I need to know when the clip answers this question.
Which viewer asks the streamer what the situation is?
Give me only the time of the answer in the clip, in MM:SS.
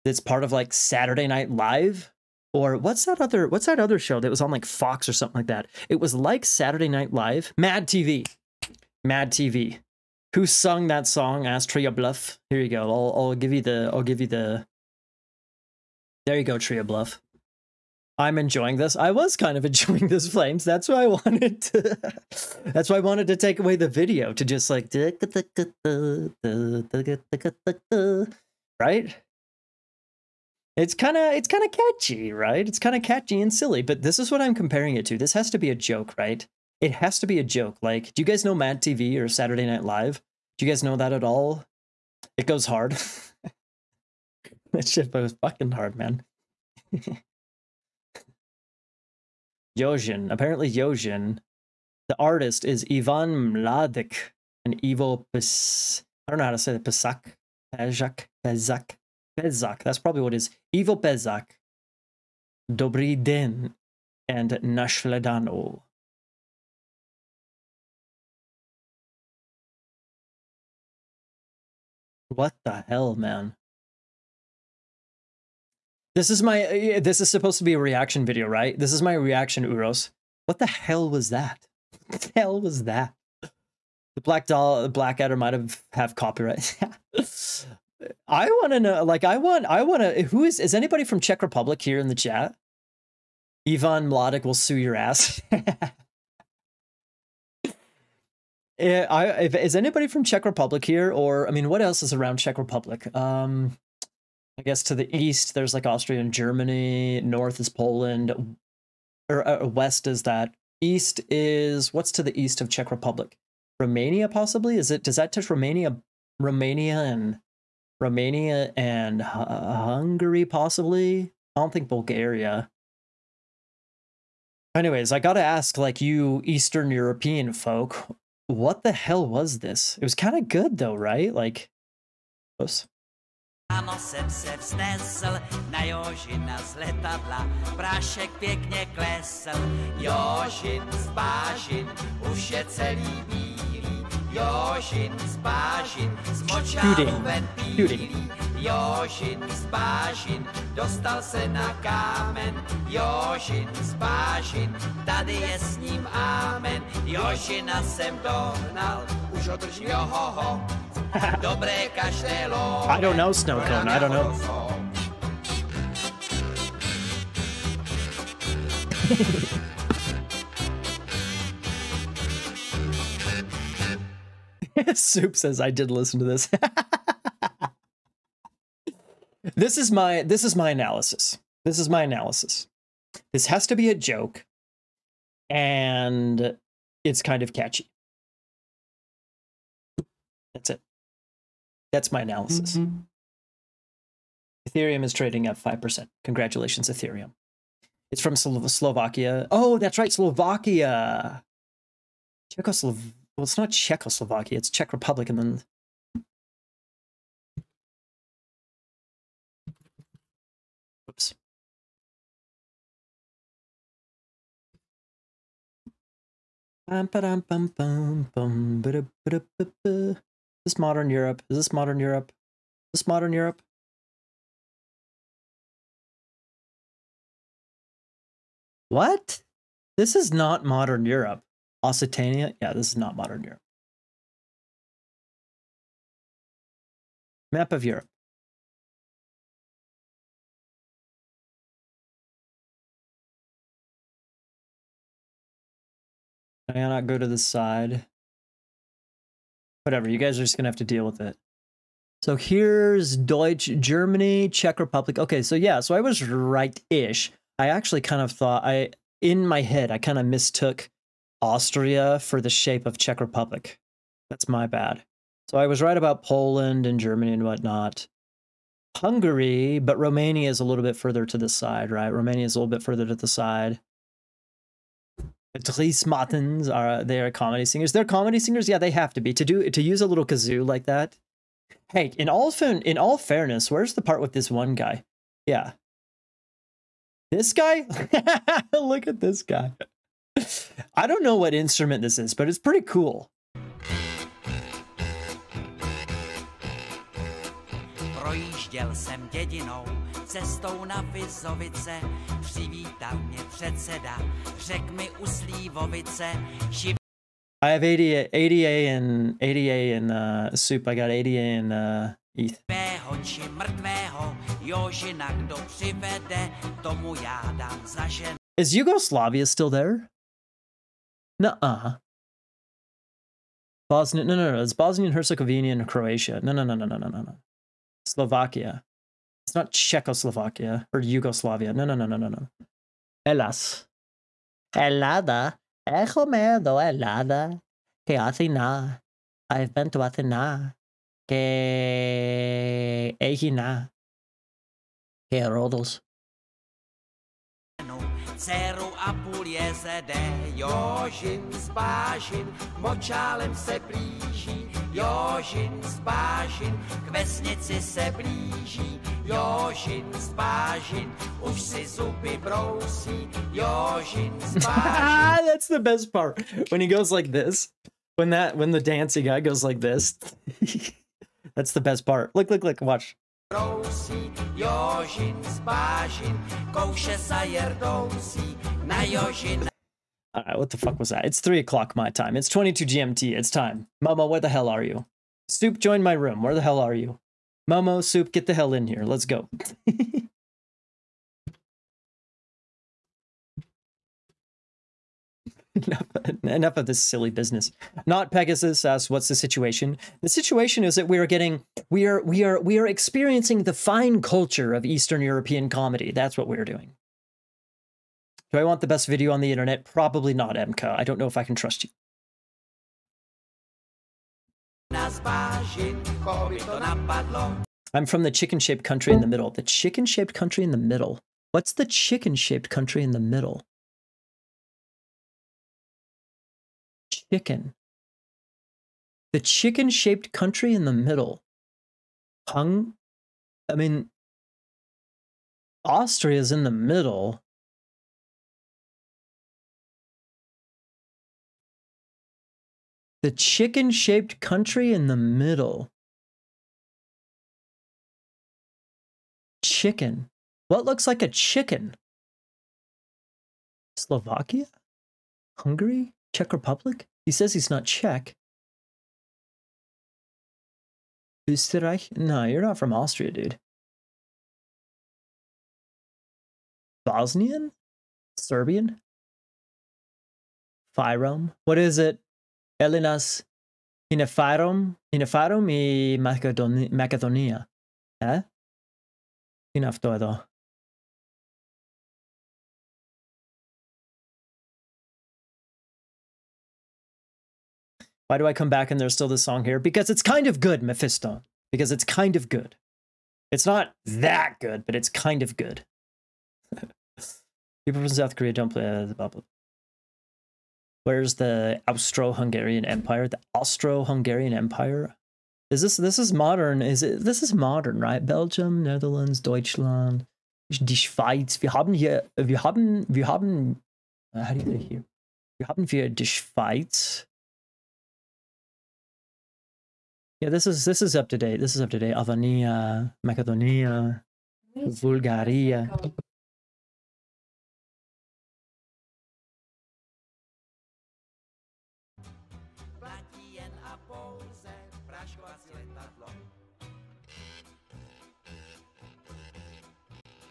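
06:38.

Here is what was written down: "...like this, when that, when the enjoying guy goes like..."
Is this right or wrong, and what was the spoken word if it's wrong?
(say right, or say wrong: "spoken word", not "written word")
wrong: "dancing", not "enjoying".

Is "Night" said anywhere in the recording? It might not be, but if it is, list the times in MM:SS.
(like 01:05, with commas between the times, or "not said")
00:01, 00:06, 00:39.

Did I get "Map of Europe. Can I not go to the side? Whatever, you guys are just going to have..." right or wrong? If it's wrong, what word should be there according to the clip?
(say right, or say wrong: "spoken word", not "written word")
right.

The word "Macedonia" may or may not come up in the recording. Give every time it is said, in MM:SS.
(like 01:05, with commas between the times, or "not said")
07:56, 08:43.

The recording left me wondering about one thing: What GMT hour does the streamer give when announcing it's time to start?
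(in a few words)
22.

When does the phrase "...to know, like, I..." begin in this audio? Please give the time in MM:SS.
01:28.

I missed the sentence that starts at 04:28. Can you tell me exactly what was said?
Hungary, but Romania is a little bit further to the side, right?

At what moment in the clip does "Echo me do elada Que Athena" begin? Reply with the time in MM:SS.
05:35.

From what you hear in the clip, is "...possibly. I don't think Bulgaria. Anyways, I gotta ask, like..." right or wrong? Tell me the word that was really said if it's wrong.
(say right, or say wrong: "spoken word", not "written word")
right.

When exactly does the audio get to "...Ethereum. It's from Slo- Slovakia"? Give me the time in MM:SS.
03:16.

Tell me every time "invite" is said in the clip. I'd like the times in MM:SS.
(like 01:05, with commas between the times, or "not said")
not said.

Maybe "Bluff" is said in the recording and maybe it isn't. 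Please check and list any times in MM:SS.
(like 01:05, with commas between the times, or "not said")
00:11, 00:16.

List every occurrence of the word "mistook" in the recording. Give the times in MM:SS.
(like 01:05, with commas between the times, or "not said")
04:20.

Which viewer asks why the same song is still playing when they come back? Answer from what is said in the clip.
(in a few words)
Mephisto.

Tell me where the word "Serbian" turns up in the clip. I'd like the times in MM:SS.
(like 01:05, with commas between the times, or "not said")
07:48.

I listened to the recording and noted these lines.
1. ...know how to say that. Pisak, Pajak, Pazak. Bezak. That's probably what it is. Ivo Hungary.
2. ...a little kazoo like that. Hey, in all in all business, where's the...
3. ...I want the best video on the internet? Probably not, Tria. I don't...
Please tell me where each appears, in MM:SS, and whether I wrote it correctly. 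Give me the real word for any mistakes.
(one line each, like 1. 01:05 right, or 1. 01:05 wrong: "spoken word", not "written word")
1. 00:56 wrong: "Bezak", not "Hungary"
2. 04:40 wrong: "fairness", not "business"
3. 06:48 wrong: "Emka", not "Tria".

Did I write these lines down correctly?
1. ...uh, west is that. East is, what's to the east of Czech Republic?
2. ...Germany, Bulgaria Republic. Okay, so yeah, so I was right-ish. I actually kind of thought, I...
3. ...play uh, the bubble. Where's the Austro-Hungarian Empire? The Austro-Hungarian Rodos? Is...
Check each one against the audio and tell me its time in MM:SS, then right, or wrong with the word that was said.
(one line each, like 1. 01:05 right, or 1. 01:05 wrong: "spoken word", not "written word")
1. 01:49 right
2. 04:13 wrong: "Czech", not "Bulgaria"
3. 08:18 wrong: "Empire", not "Rodos".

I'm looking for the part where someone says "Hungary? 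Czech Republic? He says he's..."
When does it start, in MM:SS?
07:35.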